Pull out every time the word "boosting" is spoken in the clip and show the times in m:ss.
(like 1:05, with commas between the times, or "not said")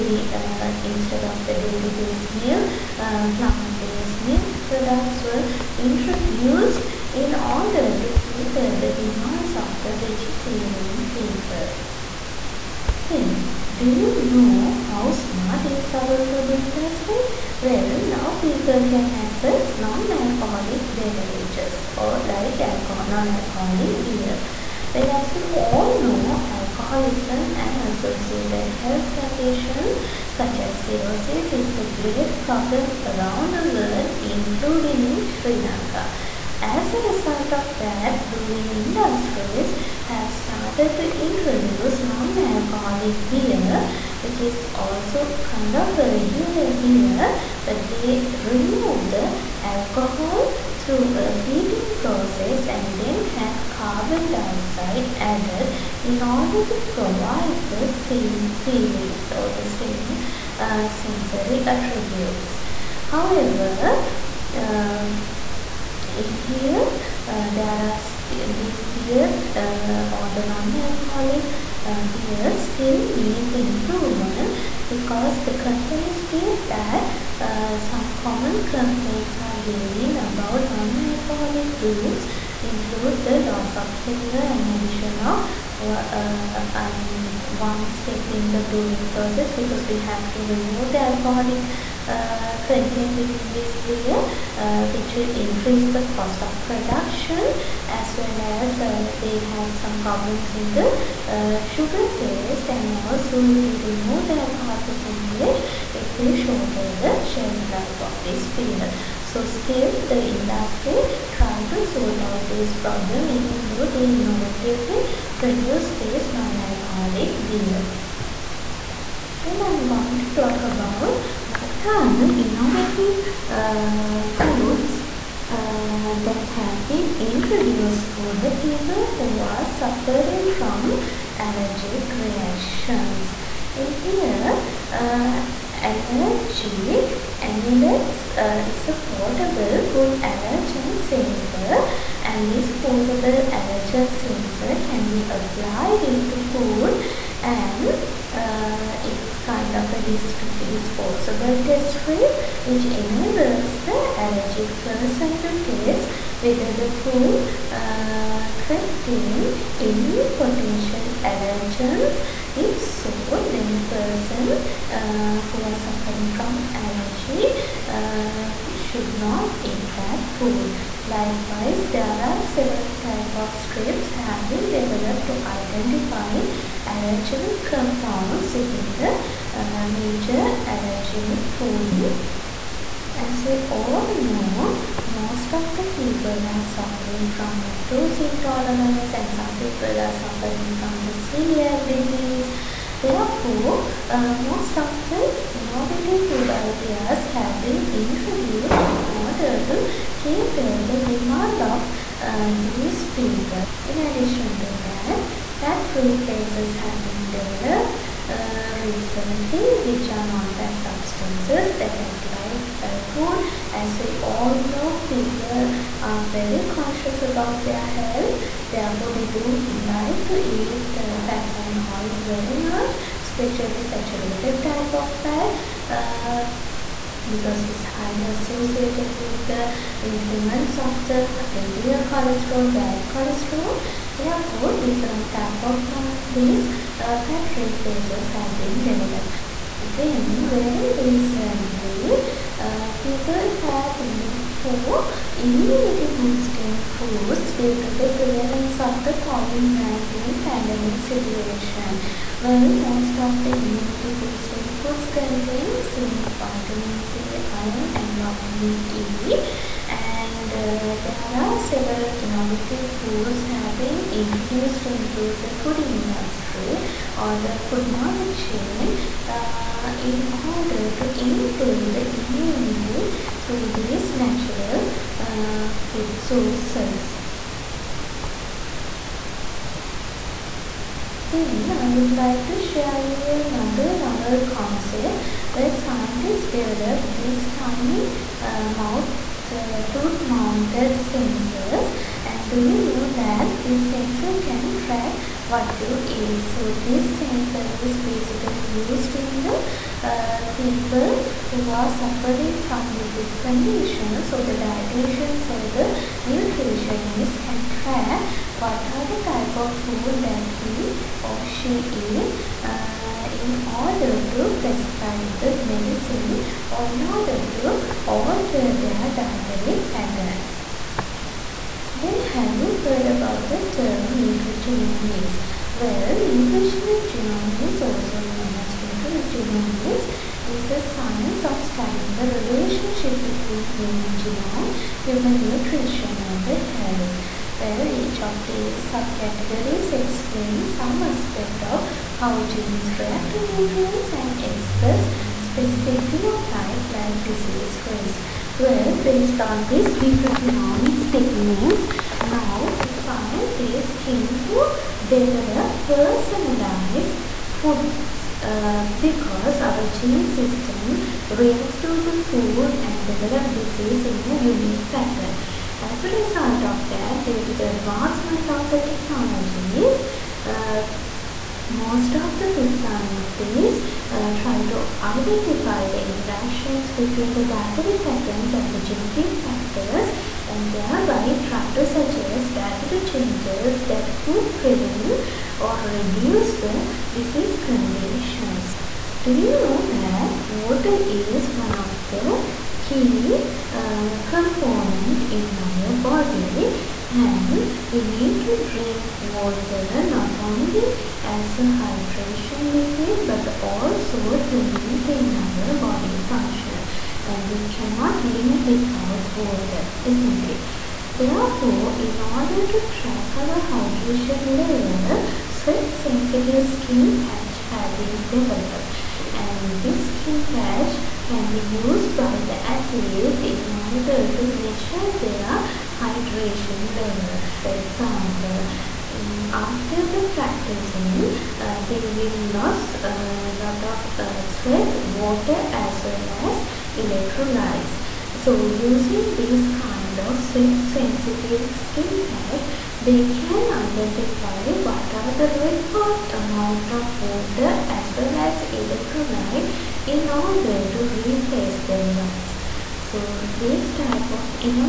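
4:06, 4:14.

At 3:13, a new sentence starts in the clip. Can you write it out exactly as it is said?
Therefore, uh, most of the innovative food ideas have been introduced in order to cater the demand of uh, these people.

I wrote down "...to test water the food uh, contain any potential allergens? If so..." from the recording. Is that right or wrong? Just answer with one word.
wrong.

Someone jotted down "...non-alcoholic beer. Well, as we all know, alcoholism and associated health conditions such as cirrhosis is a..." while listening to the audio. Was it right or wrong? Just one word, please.
right.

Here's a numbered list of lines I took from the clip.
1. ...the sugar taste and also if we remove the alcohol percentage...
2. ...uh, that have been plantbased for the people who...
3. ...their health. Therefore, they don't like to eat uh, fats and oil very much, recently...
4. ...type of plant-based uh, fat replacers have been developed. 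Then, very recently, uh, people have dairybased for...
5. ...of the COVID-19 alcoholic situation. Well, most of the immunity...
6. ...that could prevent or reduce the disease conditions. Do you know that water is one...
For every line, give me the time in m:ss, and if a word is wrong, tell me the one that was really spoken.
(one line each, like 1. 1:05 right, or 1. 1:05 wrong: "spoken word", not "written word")
1. 1:40 right
2. 2:05 wrong: "introduced", not "plantbased"
3. 3:37 wrong: "especially", not "recently"
4. 3:55 wrong: "looked", not "dairybased"
5. 4:08 wrong: "pandemic", not "alcoholic"
6. 6:23 right.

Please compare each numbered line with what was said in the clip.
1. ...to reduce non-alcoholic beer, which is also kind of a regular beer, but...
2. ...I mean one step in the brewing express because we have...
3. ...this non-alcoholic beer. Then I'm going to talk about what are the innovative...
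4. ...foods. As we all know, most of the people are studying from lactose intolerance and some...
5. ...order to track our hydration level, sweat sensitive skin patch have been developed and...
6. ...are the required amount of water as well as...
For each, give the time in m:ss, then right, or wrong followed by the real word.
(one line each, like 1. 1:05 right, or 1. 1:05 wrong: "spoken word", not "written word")
1. 0:40 wrong: "introduce", not "reduce"
2. 1:26 wrong: "process", not "express"
3. 1:55 right
4. 3:01 wrong: "suffering", not "studying"
5. 6:52 right
6. 7:25 right.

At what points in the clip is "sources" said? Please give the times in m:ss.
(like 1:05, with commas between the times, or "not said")
4:36.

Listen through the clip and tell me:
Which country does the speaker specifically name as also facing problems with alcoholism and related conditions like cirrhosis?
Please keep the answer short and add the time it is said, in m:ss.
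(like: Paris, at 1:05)
Sri Lanka, at 0:35.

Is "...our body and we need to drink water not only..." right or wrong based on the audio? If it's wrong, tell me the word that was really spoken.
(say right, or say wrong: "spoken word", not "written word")
right.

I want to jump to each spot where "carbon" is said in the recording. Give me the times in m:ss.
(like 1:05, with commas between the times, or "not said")
0:53.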